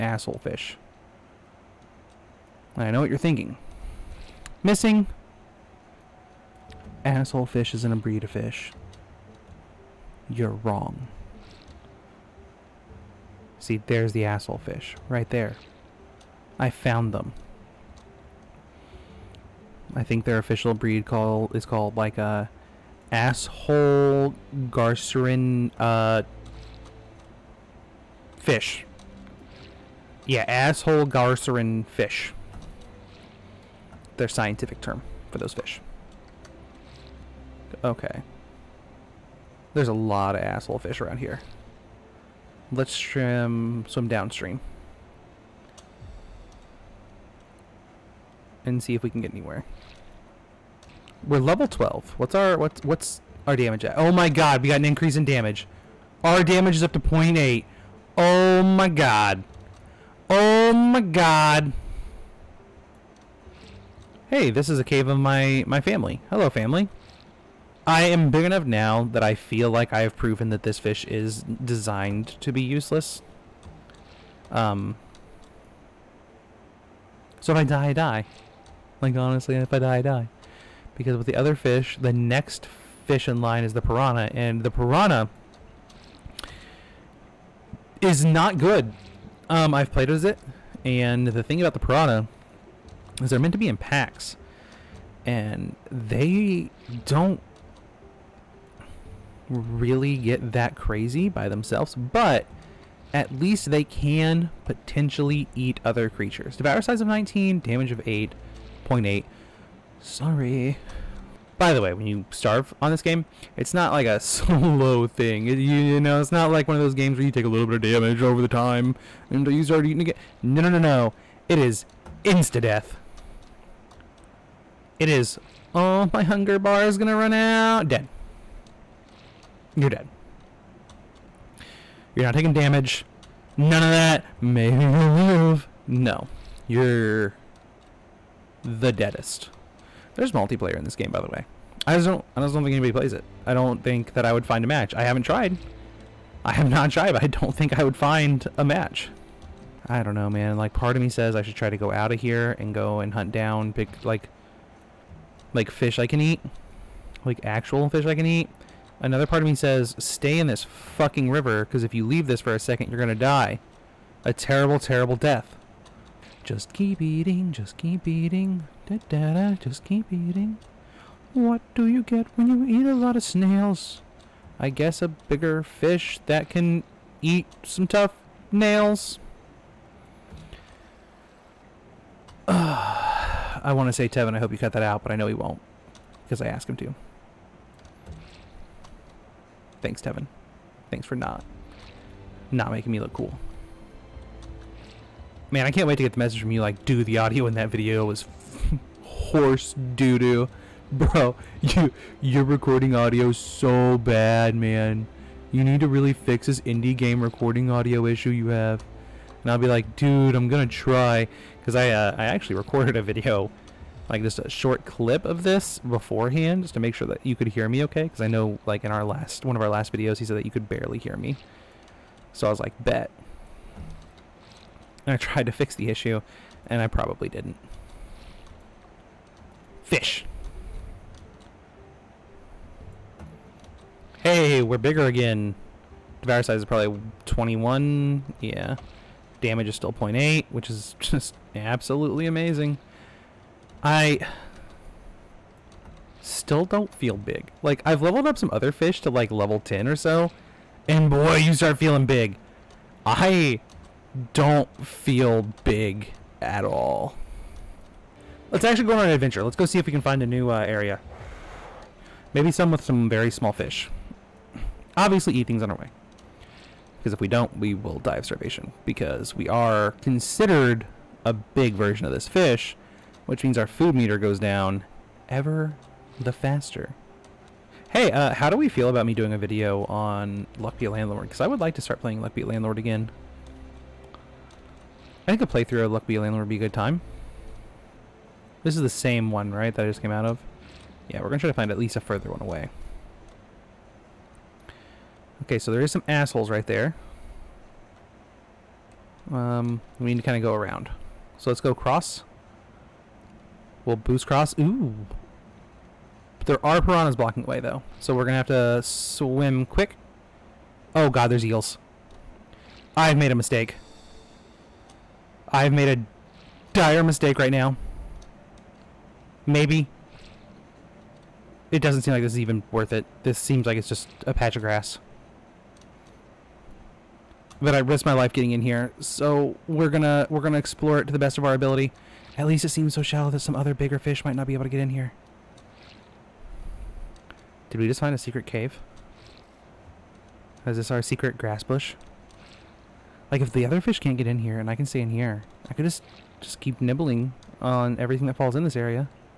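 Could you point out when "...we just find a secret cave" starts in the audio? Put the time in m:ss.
5:37.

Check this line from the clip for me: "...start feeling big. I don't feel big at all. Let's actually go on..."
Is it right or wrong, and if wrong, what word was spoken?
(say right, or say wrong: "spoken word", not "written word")
right.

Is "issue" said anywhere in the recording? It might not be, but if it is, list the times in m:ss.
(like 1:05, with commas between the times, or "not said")
3:28, 3:45.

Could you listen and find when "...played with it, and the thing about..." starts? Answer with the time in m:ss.
1:29.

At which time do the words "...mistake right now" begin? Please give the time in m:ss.
5:17.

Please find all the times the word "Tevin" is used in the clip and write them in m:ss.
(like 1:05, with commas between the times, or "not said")
3:04, 3:10.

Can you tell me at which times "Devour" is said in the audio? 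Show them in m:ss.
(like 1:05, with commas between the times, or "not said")
1:46, 3:56.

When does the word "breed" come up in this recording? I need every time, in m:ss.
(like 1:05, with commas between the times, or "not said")
0:07, 0:20.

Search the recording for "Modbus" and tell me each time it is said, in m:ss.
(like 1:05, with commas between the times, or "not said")
not said.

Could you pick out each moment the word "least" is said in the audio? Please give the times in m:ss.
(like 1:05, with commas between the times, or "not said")
1:43, 4:51, 5:32.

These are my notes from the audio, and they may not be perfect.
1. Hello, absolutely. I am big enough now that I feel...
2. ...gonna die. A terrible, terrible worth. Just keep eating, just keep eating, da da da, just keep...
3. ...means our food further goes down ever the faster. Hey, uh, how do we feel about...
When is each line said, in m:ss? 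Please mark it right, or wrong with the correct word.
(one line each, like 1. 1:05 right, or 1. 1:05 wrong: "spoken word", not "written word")
1. 1:06 wrong: "family", not "absolutely"
2. 2:42 wrong: "death", not "worth"
3. 4:33 wrong: "meter", not "further".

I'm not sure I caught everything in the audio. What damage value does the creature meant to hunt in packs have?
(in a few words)
8.8.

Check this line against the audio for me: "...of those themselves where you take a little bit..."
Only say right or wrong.
wrong.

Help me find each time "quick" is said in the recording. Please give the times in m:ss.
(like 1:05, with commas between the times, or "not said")
5:09.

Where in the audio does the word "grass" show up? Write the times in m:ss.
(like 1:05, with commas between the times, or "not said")
5:24, 5:41.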